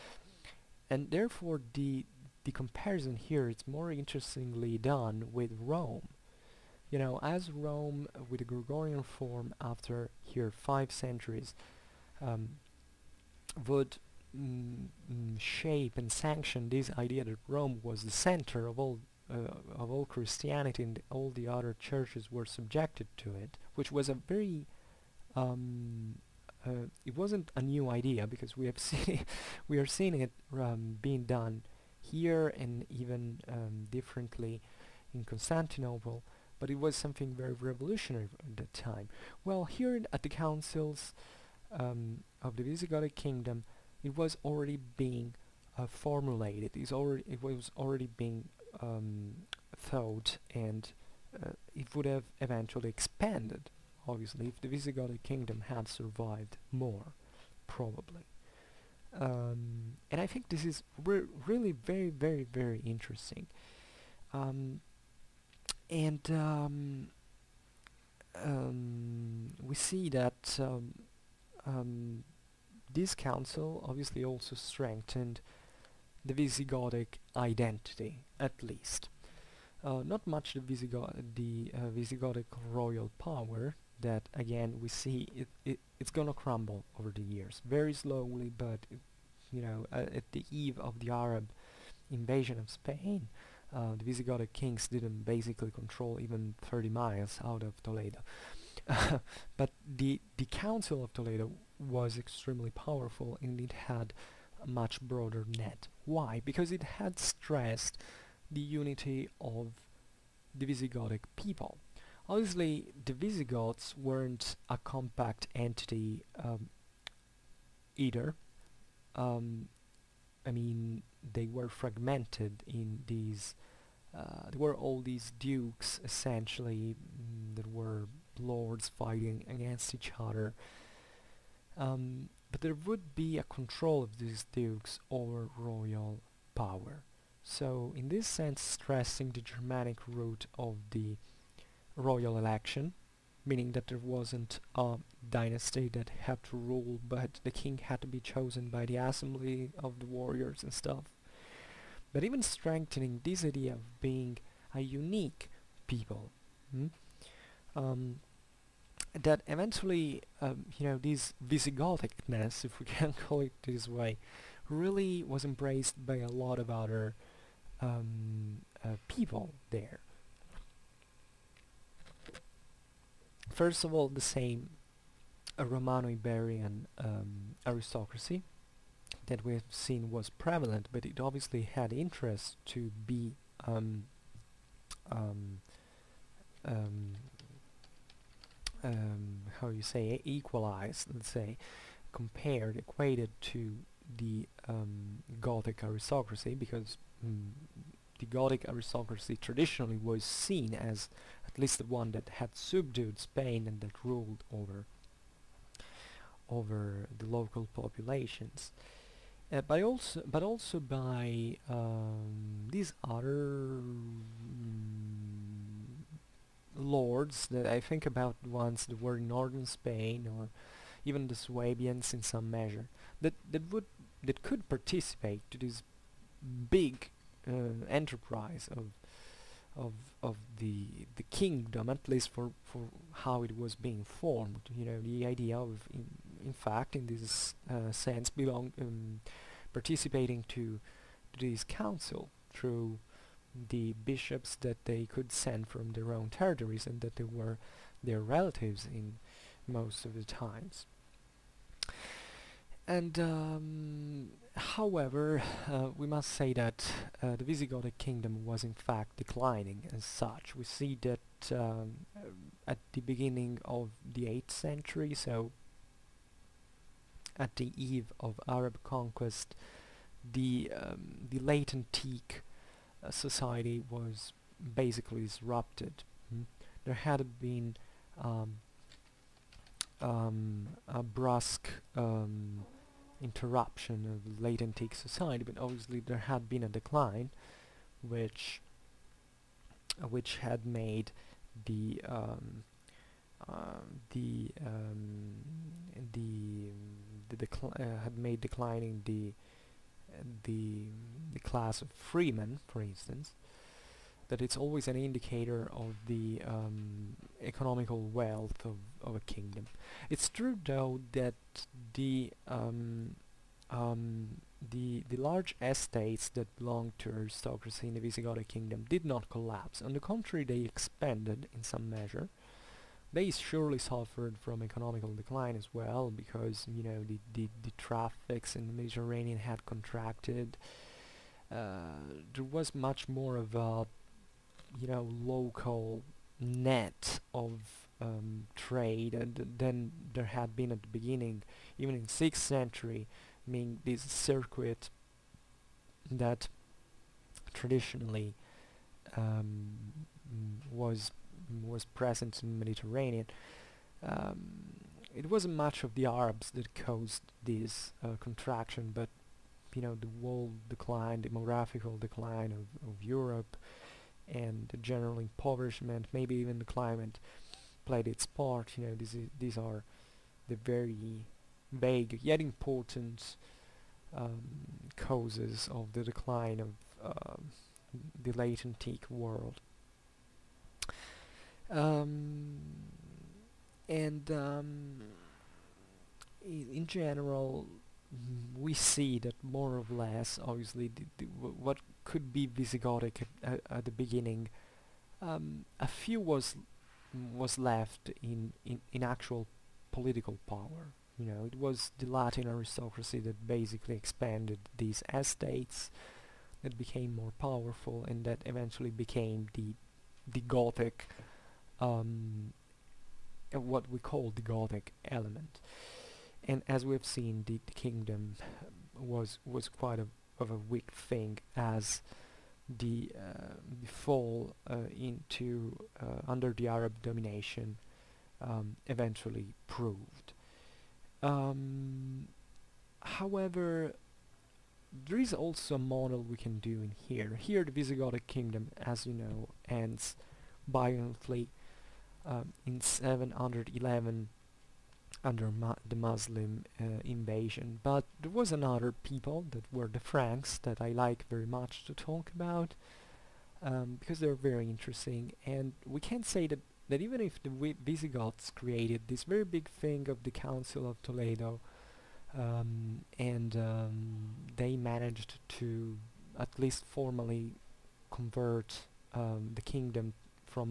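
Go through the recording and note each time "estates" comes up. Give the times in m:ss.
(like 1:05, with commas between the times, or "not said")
5:15, 6:45.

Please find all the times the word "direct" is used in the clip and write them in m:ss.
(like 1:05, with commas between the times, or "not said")
not said.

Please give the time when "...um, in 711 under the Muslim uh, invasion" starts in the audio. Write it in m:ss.
7:22.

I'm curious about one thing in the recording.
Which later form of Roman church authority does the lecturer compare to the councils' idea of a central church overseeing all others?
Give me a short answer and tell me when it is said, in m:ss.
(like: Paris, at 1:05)
Gregorian, at 0:08.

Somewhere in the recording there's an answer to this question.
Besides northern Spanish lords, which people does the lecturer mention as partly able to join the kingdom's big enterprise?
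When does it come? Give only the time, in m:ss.
3:41.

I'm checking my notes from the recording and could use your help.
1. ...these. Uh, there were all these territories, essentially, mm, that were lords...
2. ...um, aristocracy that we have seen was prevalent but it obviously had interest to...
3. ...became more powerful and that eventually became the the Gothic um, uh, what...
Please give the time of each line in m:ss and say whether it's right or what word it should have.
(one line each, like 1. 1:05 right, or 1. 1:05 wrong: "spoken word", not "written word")
1. 2:03 wrong: "dukes", not "territories"
2. 2:56 right
3. 6:46 right.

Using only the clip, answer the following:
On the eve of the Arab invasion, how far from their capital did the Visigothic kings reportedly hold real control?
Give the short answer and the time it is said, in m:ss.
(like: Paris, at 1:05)
30 miles, at 1:36.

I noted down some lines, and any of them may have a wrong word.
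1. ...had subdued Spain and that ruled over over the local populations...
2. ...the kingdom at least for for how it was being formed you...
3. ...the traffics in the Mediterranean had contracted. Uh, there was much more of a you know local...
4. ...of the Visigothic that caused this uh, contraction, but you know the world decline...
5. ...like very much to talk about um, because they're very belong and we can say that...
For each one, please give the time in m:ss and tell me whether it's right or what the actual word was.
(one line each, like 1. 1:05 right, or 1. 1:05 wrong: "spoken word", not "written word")
1. 3:22 right
2. 3:51 right
3. 5:27 right
4. 5:55 wrong: "Arabs", not "Visigothic"
5. 7:30 wrong: "interesting", not "belong".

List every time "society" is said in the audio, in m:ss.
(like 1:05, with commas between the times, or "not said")
4:33, 4:44.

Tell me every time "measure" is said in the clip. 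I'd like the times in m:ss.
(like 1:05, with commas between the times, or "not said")
3:42, 5:21.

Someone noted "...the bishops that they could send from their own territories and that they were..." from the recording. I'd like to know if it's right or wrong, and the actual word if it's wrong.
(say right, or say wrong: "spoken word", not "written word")
right.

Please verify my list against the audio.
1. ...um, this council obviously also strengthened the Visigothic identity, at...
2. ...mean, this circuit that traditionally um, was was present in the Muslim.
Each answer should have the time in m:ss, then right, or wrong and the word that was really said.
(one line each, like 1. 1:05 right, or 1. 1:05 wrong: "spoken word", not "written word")
1. 1:11 right
2. 5:43 wrong: "Mediterranean", not "Muslim".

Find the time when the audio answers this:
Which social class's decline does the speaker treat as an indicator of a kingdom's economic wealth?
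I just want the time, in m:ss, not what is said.
5:01.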